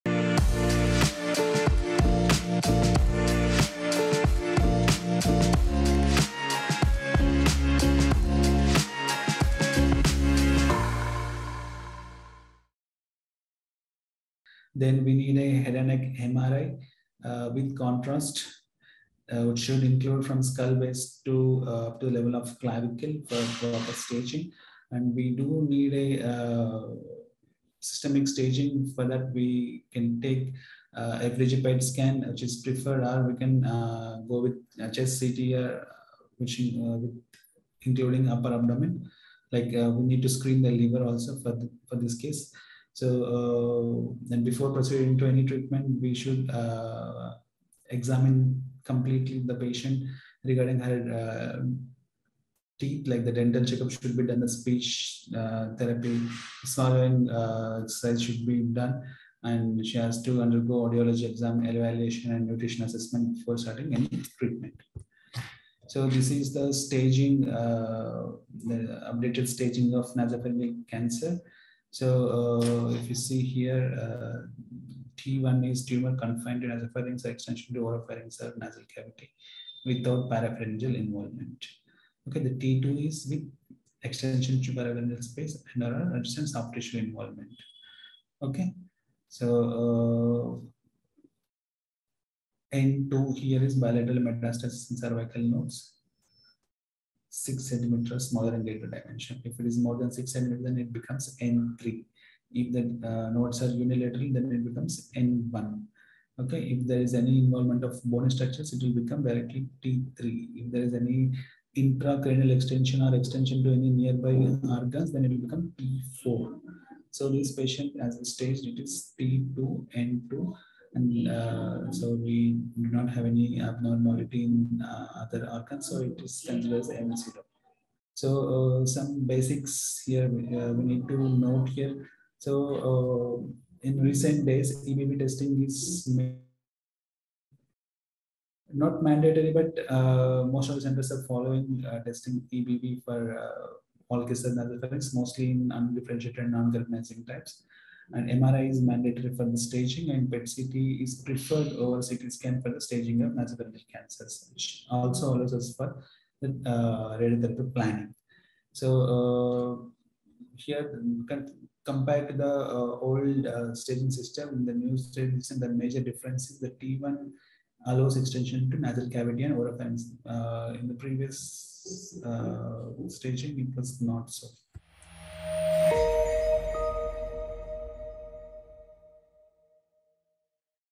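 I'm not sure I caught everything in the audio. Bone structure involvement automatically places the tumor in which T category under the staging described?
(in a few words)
T3.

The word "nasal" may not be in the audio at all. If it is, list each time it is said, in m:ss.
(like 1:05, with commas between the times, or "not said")
1:18, 2:48.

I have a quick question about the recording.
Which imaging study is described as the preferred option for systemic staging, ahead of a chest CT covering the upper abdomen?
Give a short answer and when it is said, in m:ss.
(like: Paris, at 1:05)
FDG PET scan, at 0:31.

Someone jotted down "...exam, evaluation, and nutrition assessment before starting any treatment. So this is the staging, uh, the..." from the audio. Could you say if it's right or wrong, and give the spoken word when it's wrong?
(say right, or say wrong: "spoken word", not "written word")
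right.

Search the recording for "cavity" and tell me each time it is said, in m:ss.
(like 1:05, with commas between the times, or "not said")
1:18, 2:49.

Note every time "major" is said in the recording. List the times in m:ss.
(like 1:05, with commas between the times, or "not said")
2:45.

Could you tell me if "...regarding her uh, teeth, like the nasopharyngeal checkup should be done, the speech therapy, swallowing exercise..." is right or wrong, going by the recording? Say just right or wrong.
wrong.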